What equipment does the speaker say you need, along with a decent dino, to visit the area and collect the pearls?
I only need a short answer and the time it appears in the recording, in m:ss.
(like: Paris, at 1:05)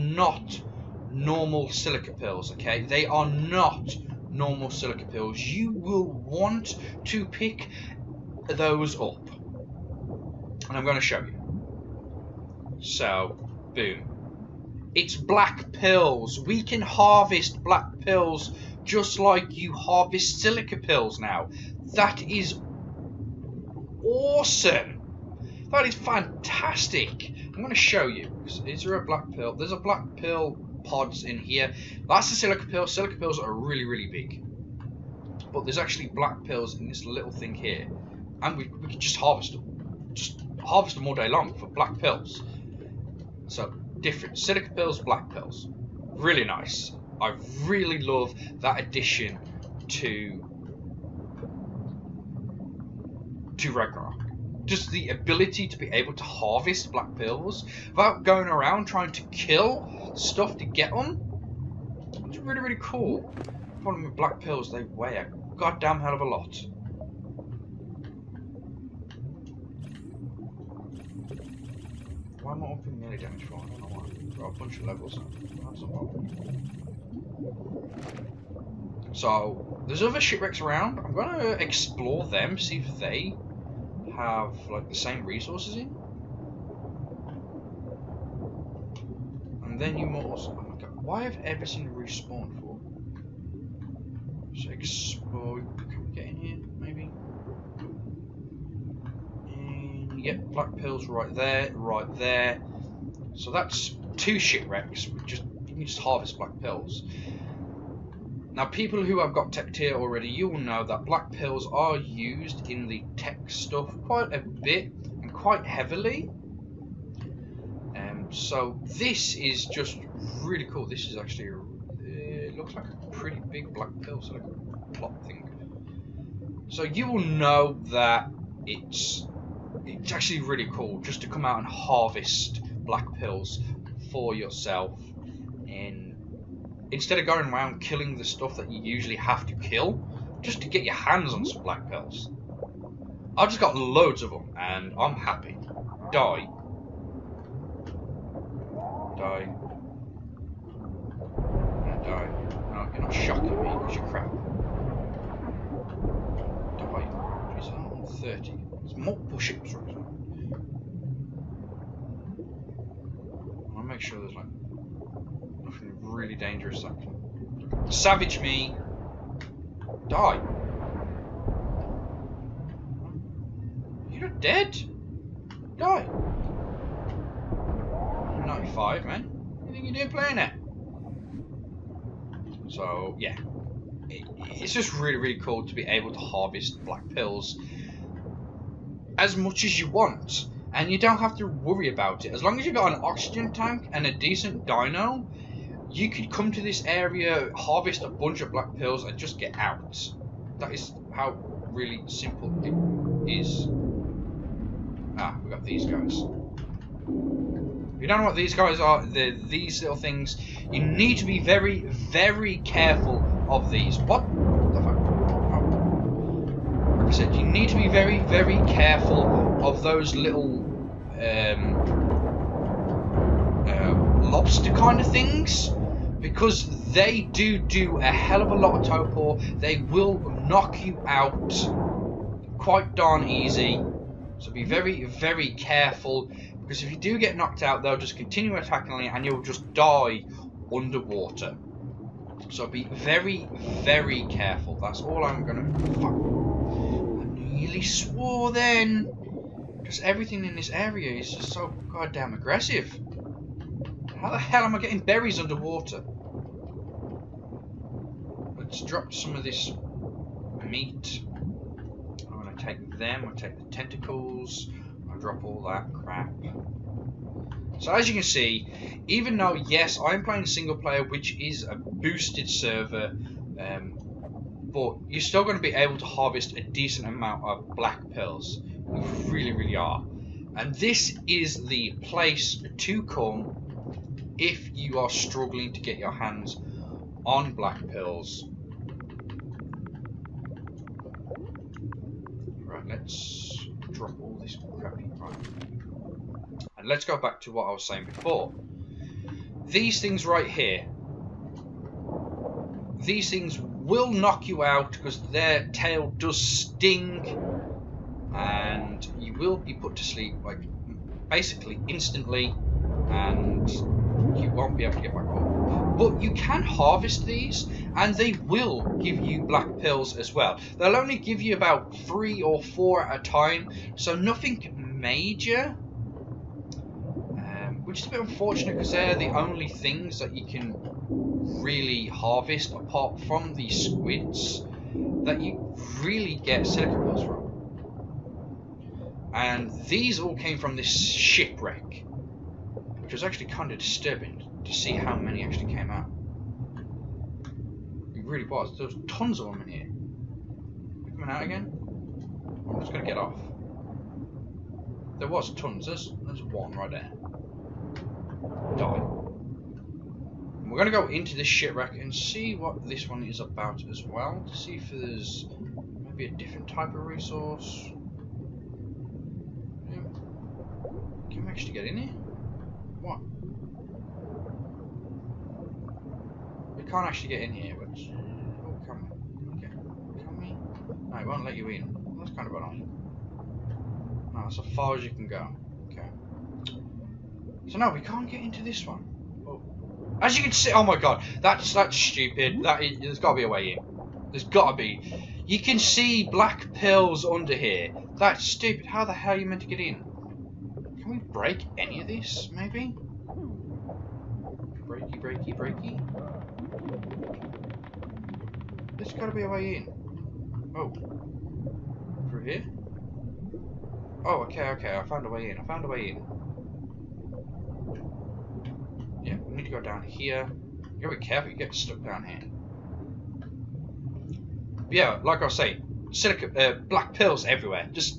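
An oxygen tank, at 3:13.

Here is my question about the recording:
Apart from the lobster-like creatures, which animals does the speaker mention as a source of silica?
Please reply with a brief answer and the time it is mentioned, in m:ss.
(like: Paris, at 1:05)
Squids, at 5:33.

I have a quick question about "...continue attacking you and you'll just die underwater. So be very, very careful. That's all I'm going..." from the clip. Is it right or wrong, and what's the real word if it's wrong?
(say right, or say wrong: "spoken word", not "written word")
right.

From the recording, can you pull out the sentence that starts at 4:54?
And let's go back to what I was saying before.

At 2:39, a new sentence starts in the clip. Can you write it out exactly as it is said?
right make sure there's like nothing really dangerous that can savage me.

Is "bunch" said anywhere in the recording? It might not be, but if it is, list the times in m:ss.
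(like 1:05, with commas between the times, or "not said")
1:14, 3:18.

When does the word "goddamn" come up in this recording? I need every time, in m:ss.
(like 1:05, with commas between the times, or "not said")
1:05, 4:11.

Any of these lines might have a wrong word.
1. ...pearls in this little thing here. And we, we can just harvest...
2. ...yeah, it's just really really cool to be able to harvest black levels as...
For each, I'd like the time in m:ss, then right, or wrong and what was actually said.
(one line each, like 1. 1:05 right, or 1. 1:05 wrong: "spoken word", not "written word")
1. 0:36 right
2. 3:03 wrong: "pearls", not "levels".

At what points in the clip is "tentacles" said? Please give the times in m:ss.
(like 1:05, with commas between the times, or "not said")
4:23.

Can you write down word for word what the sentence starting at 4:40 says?
And this is the place to come if you are struggling to get your hands on black pearls.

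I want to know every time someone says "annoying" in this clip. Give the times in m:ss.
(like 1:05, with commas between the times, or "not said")
6:22.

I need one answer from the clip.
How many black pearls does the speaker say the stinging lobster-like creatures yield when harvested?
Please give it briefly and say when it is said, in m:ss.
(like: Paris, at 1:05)
3 or 4, at 5:21.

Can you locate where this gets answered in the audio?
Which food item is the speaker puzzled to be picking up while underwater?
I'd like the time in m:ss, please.
4:14.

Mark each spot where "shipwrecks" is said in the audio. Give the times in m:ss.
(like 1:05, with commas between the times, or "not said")
1:20, 1:44, 5:40.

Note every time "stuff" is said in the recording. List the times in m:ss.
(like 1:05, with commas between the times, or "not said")
1:00, 1:53, 2:18.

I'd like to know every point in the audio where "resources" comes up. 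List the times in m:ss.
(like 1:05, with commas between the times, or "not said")
1:25, 6:07.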